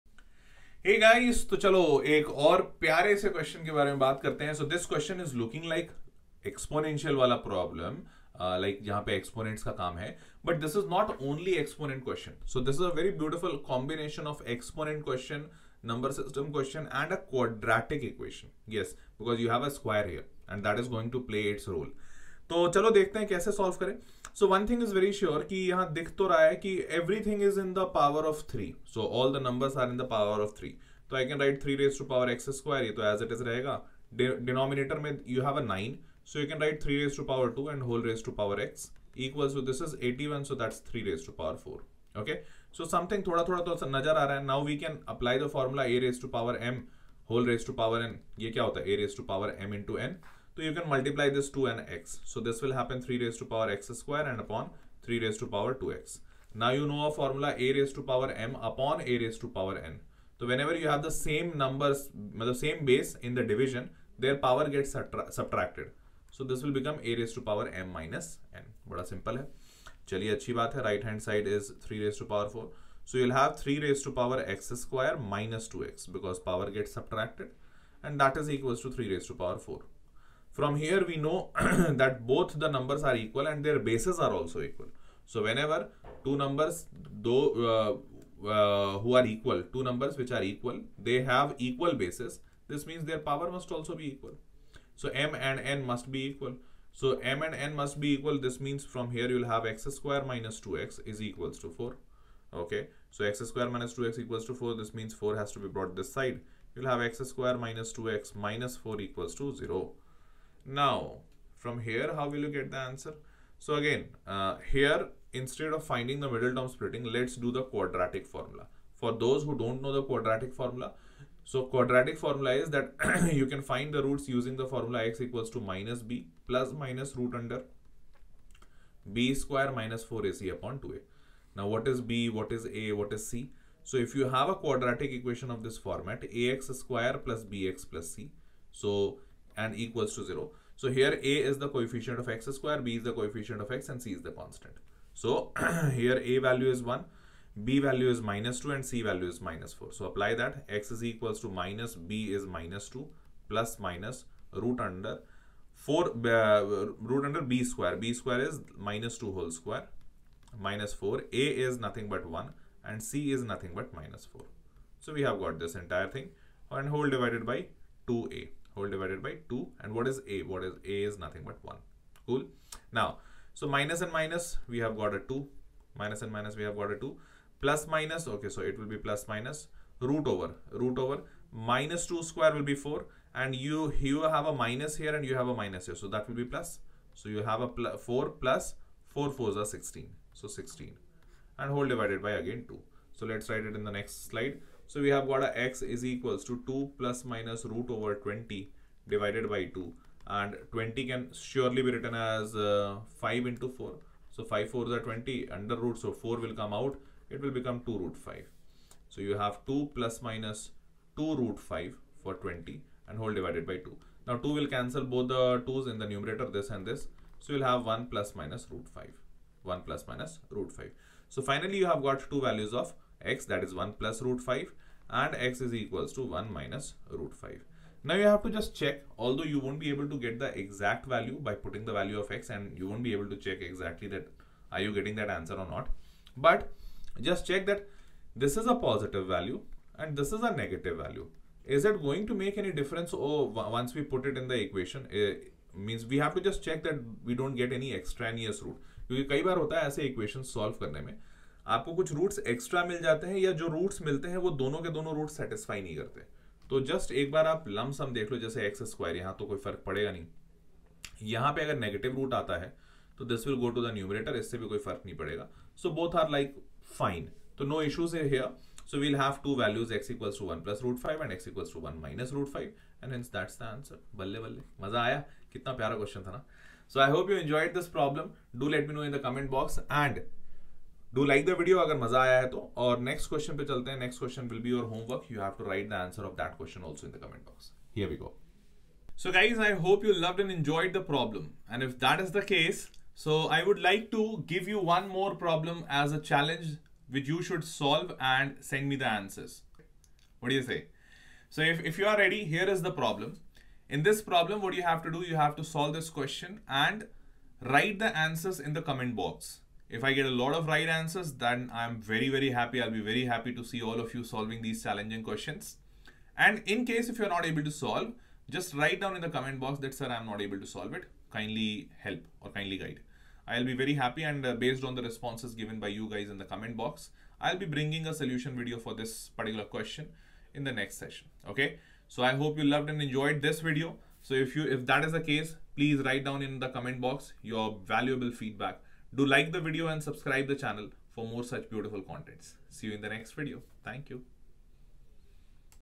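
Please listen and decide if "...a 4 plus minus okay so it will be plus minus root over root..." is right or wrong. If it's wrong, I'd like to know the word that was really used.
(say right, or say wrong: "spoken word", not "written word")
wrong: "2", not "4".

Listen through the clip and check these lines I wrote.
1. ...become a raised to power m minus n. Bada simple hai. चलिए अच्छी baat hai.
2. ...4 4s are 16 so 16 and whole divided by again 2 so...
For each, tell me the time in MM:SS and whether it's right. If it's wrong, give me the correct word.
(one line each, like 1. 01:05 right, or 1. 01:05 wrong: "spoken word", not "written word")
1. 01:06 right
2. 03:09 right.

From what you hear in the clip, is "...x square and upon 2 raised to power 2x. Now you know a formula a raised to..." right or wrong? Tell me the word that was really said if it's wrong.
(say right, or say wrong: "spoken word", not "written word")
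wrong: "3", not "2".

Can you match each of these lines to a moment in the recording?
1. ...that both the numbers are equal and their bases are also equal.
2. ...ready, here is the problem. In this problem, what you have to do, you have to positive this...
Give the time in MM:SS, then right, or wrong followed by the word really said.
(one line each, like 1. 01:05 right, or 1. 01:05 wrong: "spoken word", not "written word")
1. 01:21 right
2. 05:02 wrong: "solve", not "positive".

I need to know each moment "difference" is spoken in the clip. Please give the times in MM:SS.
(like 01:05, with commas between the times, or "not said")
04:02.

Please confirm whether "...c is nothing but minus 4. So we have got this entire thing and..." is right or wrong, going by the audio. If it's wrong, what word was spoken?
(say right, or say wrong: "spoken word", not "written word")
right.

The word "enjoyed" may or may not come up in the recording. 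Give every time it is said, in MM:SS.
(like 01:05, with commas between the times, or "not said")
04:50, 05:33.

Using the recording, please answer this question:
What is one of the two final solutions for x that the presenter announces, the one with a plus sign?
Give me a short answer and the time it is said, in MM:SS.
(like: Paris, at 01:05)
1 + √5, at 03:43.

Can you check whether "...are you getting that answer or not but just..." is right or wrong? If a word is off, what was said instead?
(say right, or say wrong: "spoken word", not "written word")
right.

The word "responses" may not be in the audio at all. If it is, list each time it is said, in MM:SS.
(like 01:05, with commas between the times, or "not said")
05:25.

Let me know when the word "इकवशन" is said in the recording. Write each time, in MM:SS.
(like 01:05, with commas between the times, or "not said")
00:18, 04:10.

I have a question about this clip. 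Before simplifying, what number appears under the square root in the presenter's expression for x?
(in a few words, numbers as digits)
20.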